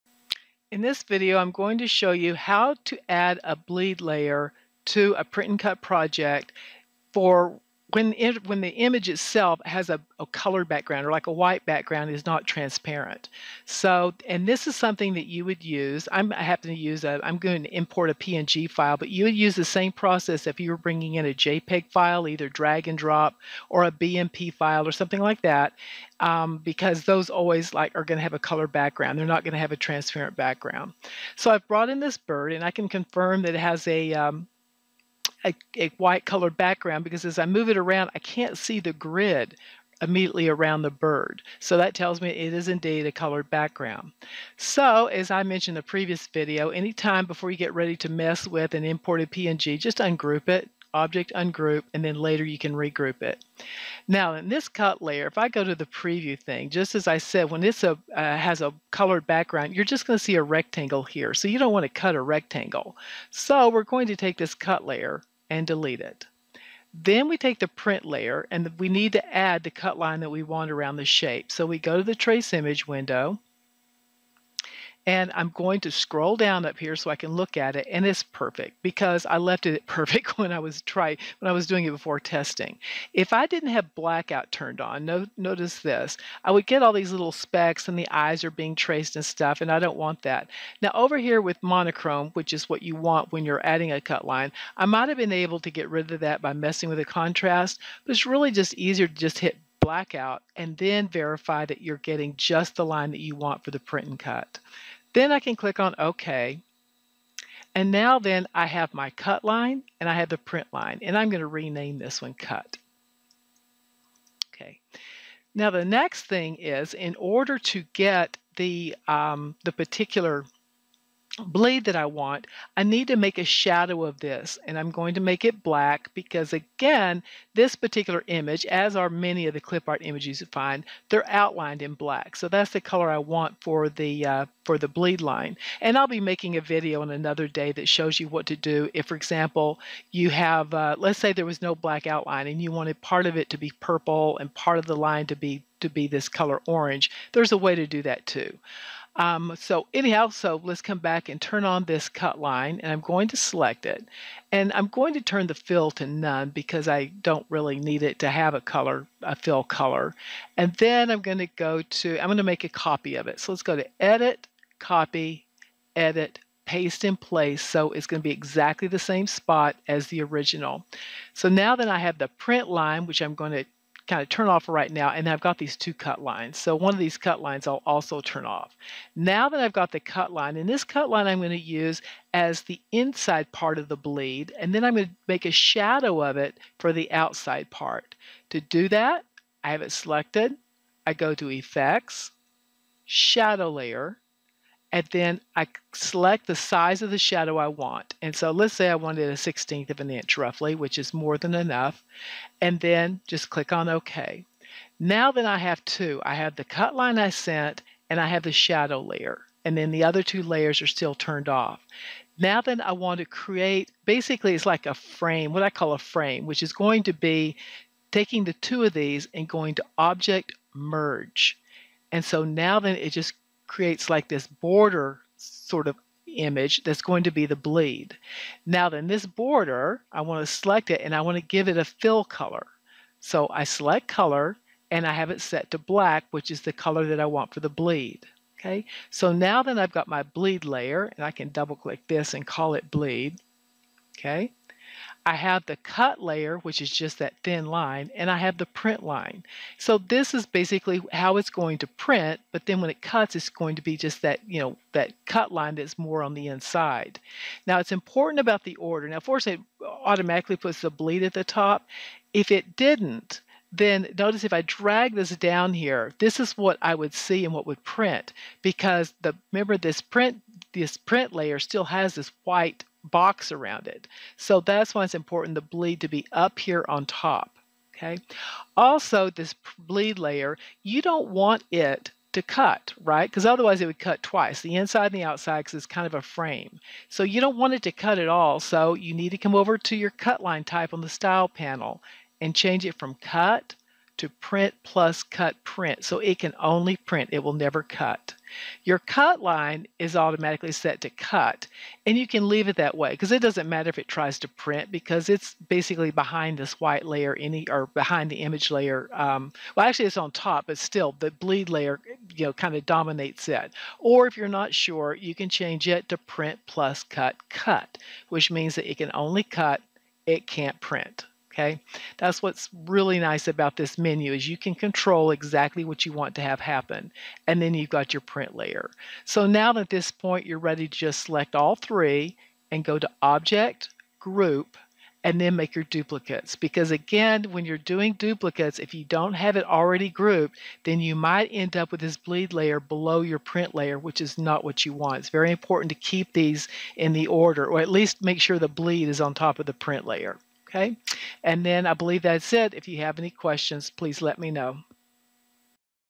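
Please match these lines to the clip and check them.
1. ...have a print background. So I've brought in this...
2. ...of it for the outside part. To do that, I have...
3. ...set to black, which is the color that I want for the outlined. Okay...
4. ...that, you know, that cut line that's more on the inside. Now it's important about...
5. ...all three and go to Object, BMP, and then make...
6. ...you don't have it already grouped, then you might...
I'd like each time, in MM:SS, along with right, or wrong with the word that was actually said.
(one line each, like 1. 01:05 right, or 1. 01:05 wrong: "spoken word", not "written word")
1. 00:29 wrong: "transparent", not "print"
2. 03:06 right
3. 03:55 wrong: "bleed", not "outlined"
4. 04:14 right
5. 05:31 wrong: "Group", not "BMP"
6. 05:38 right.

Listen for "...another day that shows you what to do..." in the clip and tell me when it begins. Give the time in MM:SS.
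02:17.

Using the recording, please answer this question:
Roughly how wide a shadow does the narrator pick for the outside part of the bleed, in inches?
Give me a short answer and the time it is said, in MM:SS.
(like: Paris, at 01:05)
1/16 inch, at 03:19.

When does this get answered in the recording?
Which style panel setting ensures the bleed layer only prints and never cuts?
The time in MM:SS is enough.
04:54.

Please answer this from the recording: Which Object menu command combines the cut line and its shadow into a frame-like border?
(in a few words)
merge.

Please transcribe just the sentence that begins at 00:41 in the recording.
So that tells me it is indeed a colored background.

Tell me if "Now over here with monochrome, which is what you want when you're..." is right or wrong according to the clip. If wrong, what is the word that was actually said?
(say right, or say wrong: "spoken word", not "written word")
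right.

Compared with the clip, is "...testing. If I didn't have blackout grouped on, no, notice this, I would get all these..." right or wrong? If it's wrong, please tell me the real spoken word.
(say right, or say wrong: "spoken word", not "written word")
wrong: "turned", not "grouped".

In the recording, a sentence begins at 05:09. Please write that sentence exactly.
Um, well, actually, it's on top, but still the bleed layer, you know, kind of dominates it.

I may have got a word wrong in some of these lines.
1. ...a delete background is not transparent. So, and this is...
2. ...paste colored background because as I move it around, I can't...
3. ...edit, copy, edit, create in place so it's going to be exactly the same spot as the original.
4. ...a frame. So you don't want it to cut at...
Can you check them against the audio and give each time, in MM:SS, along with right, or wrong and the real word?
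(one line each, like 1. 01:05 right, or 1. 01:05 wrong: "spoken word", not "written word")
1. 00:11 wrong: "white", not "delete"
2. 00:35 wrong: "white", not "paste"
3. 02:43 wrong: "paste", not "create"
4. 04:46 right.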